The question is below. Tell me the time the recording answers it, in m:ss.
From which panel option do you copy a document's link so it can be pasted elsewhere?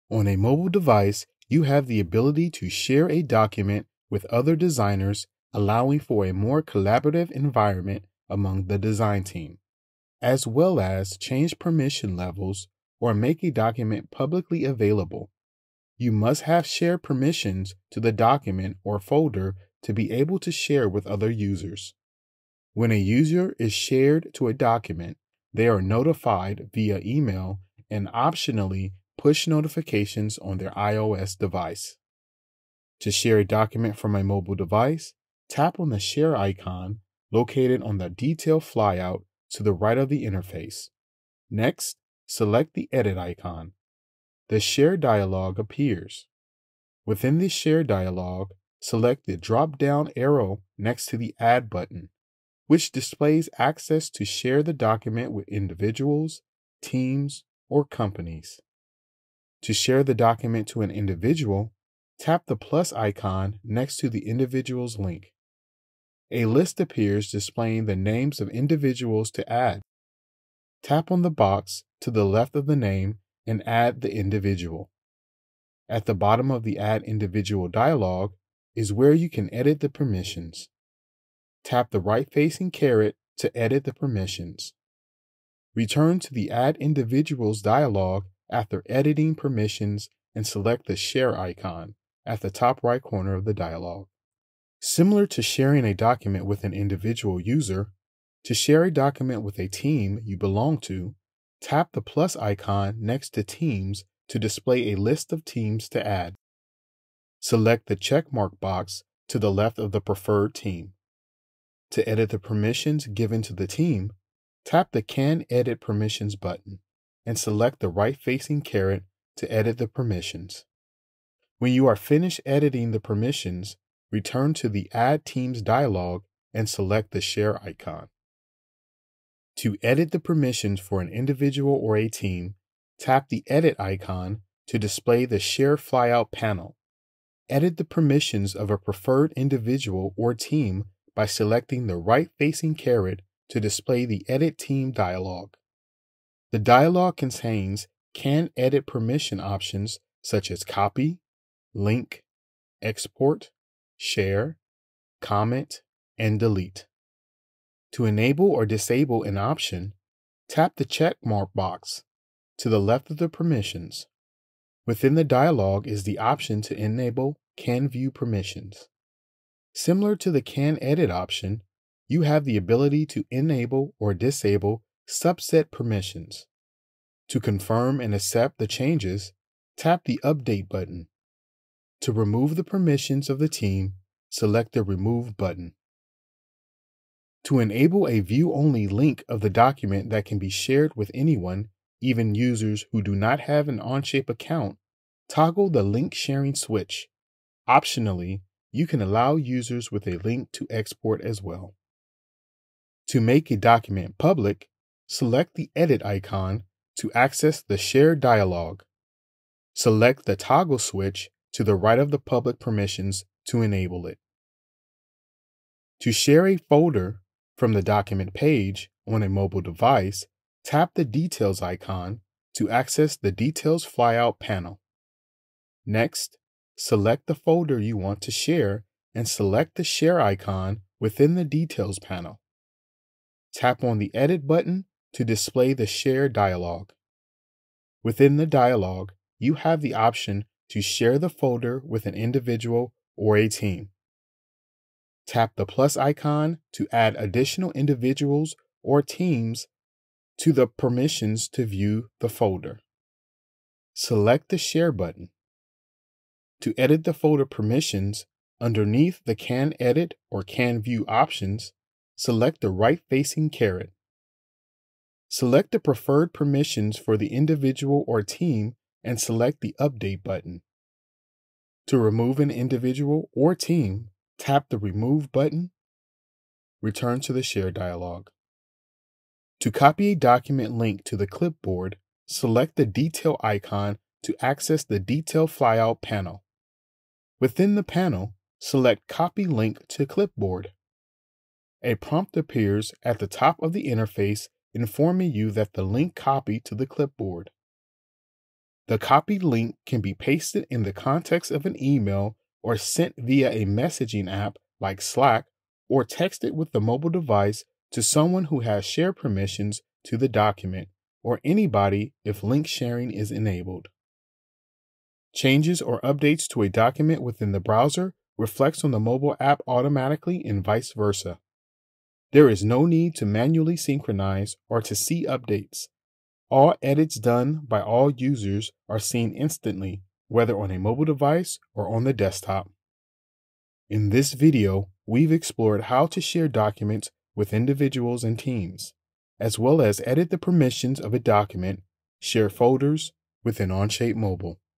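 4:49.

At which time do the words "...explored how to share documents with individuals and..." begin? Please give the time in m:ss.
5:35.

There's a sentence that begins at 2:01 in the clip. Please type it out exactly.
When you are finished editing the permissions, return to the Add Teams dialog and select the Share icon.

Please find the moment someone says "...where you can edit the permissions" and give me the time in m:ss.
1:18.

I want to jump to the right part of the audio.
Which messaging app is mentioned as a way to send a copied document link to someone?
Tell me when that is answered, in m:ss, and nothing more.
5:05.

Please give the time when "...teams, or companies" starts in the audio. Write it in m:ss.
0:56.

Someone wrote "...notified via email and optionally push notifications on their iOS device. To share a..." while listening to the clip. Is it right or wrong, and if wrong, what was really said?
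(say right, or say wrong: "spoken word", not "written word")
right.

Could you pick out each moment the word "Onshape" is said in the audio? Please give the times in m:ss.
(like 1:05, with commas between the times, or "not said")
3:13, 5:43.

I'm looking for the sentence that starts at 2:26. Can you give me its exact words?
The dialog contains can edit permission options such as copy, link, export, share, comment, and delete.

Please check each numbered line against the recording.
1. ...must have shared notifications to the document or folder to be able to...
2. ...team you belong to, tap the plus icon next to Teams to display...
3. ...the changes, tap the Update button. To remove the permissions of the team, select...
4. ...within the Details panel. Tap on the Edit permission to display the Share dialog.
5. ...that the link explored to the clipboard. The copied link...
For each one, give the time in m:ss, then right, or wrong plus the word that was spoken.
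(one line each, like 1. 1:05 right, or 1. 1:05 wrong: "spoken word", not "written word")
1. 0:16 wrong: "permissions", not "notifications"
2. 1:39 right
3. 2:58 right
4. 3:51 wrong: "button", not "permission"
5. 4:55 wrong: "copied", not "explored".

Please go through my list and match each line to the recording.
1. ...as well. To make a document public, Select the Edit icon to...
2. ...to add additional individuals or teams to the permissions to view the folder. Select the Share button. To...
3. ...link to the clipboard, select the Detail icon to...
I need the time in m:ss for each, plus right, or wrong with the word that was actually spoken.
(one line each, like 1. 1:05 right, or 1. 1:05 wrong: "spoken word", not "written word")
1. 3:21 right
2. 4:06 right
3. 4:40 right.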